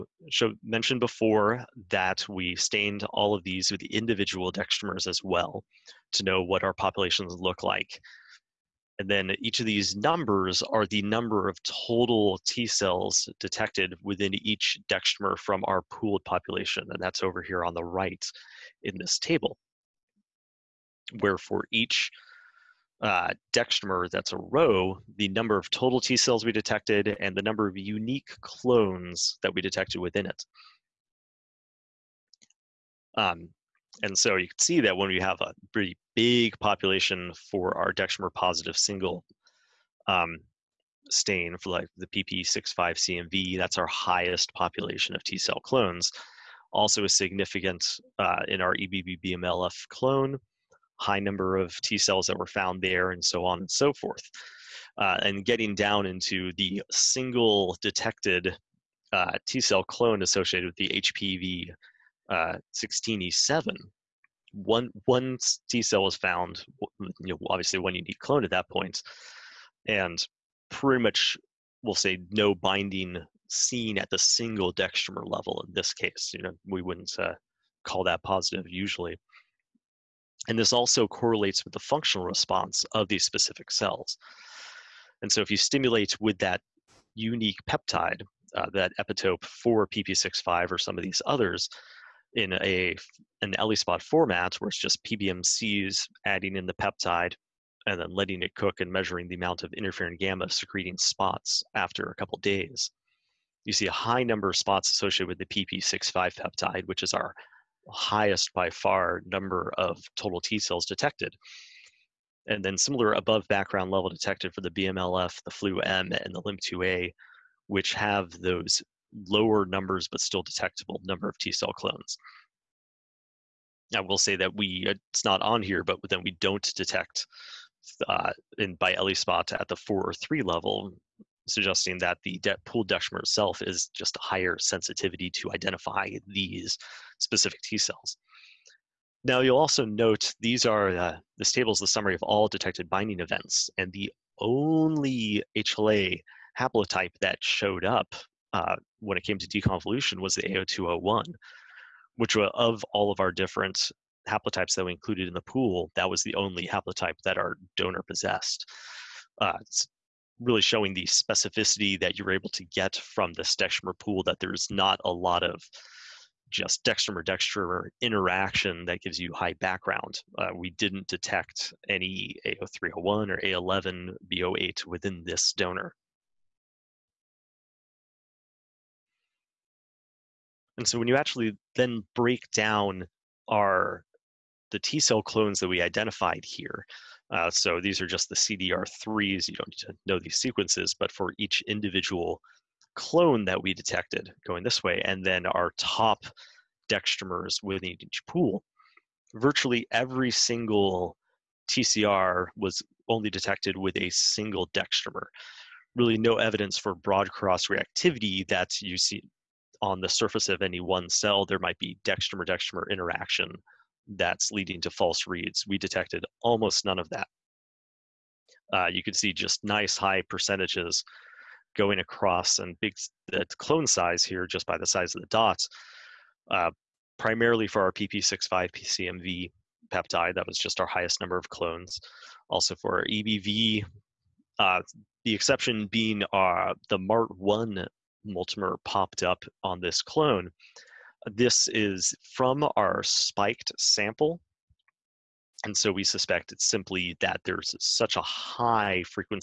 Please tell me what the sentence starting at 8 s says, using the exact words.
And then each of these numbers are the number of total T cells detected within each dextramer from our pooled population.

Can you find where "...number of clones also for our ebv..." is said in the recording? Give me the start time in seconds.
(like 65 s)
231 s.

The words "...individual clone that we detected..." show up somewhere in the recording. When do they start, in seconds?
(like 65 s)
191 s.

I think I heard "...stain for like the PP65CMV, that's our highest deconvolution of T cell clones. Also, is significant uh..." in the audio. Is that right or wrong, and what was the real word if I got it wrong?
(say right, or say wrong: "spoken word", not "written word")
wrong: "population", not "deconvolution".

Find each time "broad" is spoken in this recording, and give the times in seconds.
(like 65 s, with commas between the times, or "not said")
206 s.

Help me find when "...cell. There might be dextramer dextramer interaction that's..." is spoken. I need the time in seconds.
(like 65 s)
211 s.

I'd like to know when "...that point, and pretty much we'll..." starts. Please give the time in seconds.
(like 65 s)
68 s.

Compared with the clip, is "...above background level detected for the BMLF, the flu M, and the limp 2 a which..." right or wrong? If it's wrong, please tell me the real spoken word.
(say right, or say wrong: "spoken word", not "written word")
right.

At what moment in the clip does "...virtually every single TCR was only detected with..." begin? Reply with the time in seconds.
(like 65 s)
199 s.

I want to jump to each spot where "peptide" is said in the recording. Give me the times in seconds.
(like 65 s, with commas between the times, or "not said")
87 s, 96 s, 106 s, 229 s.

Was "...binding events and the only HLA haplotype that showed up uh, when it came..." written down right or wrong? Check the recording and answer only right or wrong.
right.